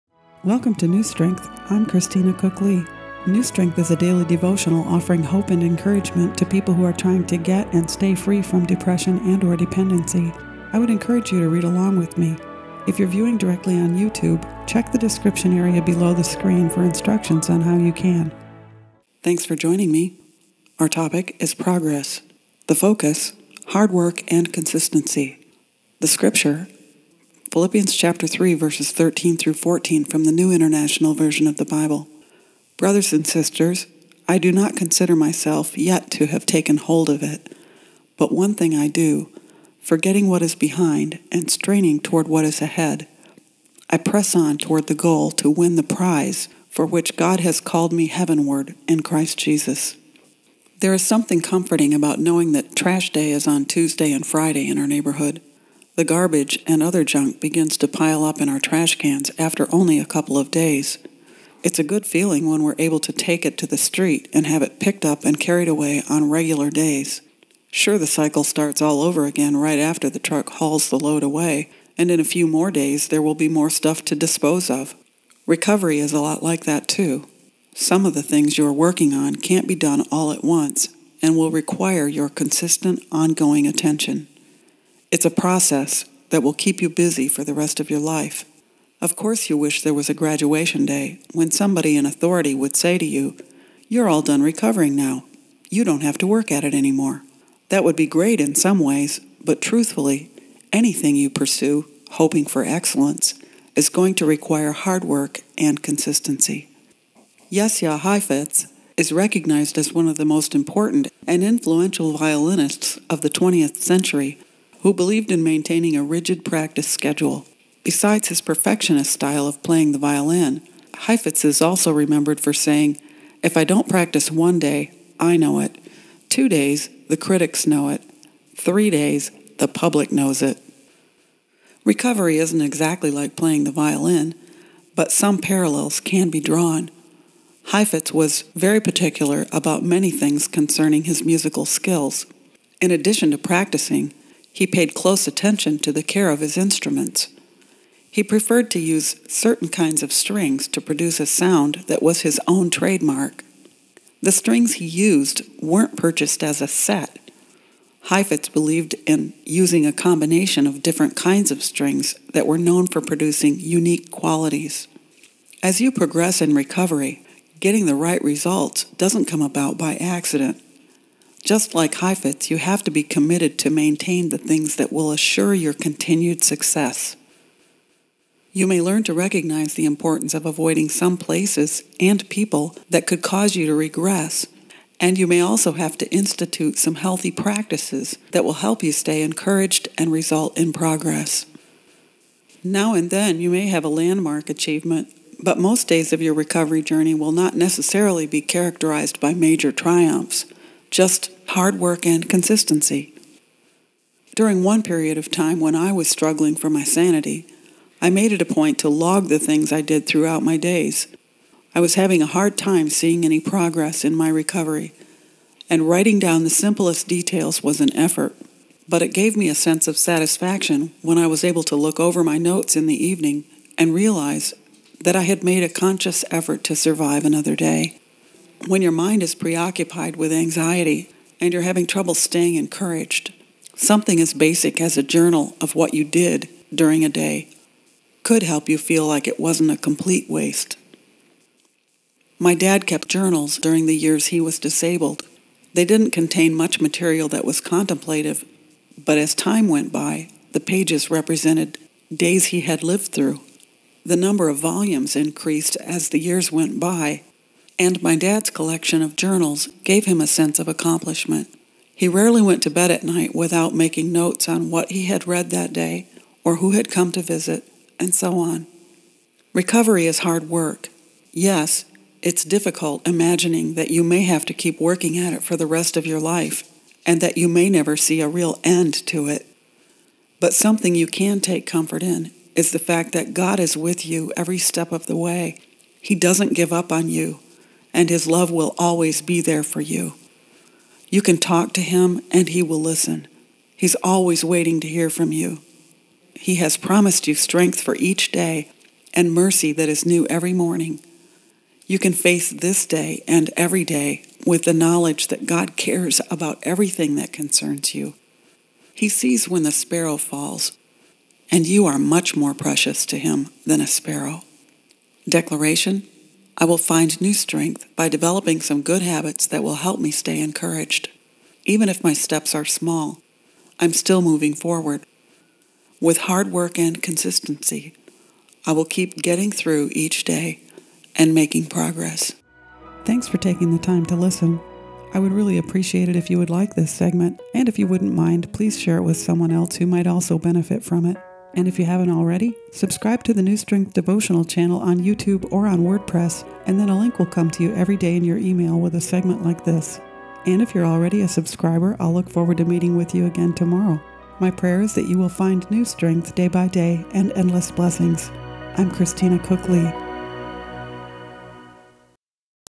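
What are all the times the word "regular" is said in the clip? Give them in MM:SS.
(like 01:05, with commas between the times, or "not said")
01:06.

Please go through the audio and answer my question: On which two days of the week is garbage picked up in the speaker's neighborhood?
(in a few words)
Tuesday and Friday.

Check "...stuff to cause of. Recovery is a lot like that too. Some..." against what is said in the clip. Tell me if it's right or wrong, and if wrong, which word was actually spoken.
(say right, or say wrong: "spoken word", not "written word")
wrong: "dispose", not "cause".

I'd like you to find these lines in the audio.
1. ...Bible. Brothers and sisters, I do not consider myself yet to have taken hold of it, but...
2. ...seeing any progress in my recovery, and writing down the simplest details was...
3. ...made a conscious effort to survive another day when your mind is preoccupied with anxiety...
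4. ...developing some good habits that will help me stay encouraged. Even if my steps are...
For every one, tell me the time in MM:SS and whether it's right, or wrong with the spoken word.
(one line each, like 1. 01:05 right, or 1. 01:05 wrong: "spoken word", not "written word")
1. 00:31 right
2. 03:32 right
3. 03:45 right
4. 05:18 right.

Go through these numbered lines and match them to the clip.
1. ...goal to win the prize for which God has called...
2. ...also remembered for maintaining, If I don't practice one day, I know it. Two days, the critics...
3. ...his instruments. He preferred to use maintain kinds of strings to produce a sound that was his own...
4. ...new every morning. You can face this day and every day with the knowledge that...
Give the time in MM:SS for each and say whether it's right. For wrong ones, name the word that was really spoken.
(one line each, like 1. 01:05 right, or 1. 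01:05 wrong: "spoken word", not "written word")
1. 00:44 right
2. 02:01 wrong: "saying", not "maintaining"
3. 02:26 wrong: "certain", not "maintain"
4. 05:00 right.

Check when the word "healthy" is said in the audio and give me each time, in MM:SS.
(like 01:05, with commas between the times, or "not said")
03:06.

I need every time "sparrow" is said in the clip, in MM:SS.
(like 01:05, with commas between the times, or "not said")
05:09, 05:13.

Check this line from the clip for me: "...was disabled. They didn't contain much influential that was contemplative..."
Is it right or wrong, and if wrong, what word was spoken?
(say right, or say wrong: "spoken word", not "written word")
wrong: "material", not "influential".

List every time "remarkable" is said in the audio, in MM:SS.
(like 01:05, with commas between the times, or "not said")
not said.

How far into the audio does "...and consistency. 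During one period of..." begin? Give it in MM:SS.
03:22.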